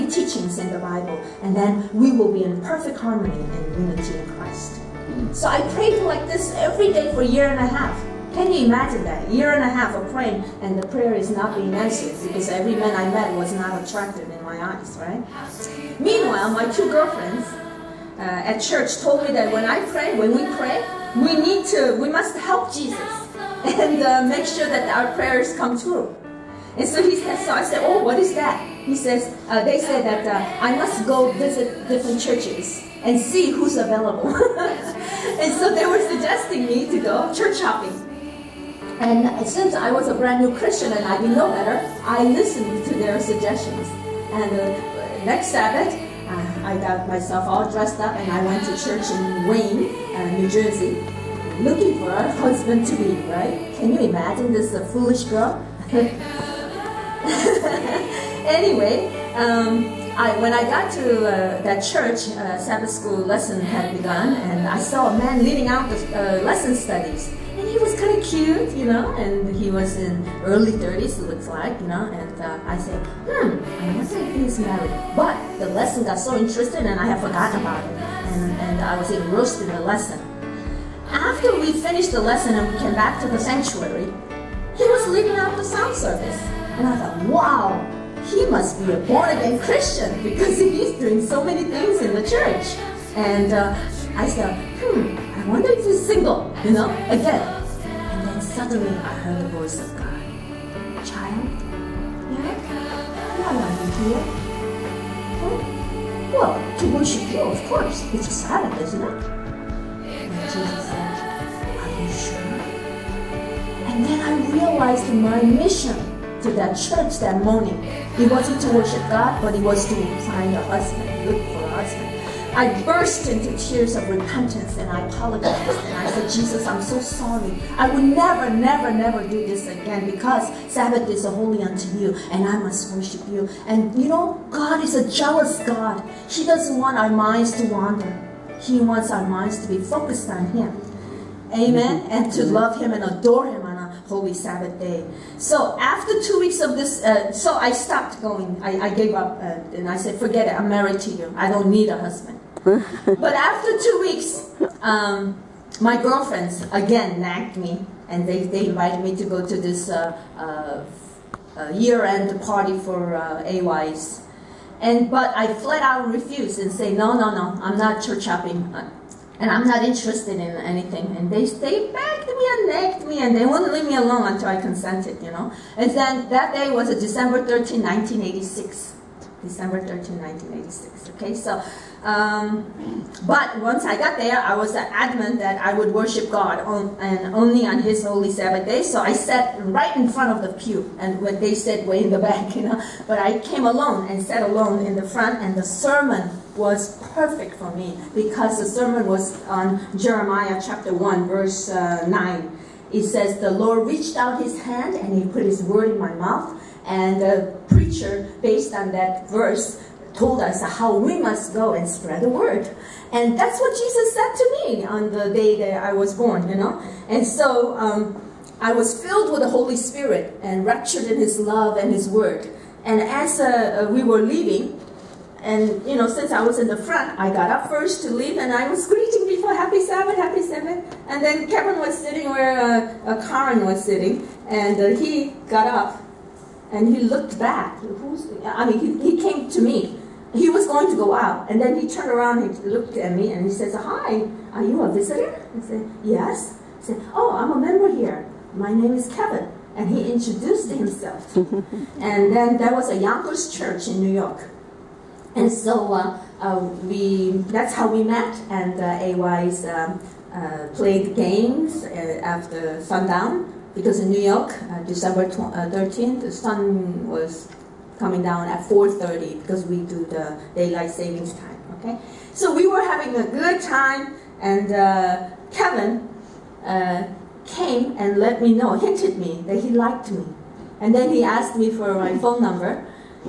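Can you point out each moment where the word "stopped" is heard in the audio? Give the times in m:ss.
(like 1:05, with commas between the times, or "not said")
2:27.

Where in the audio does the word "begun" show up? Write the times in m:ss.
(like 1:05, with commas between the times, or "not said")
1:03.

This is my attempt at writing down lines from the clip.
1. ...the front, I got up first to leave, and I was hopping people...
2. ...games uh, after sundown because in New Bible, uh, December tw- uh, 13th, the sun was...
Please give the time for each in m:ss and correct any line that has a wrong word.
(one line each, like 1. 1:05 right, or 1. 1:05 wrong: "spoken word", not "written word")
1. 3:46 wrong: "greeting", not "hopping"
2. 4:21 wrong: "York", not "Bible".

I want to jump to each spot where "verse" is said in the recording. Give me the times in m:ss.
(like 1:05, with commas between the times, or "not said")
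3:21, 3:29.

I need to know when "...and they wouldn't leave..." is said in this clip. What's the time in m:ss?
2:53.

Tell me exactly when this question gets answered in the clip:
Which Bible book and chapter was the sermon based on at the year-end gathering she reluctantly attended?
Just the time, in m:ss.
3:19.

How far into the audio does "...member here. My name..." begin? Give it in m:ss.
4:07.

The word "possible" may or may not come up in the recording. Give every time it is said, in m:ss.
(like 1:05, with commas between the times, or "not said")
not said.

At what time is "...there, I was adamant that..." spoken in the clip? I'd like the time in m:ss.
3:04.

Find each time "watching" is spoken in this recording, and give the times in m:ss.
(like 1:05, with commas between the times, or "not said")
not said.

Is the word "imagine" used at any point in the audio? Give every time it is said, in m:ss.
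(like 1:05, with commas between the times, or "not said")
0:08, 0:54.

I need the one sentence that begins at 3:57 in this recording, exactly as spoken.
Who's, I mean, he, he came to me.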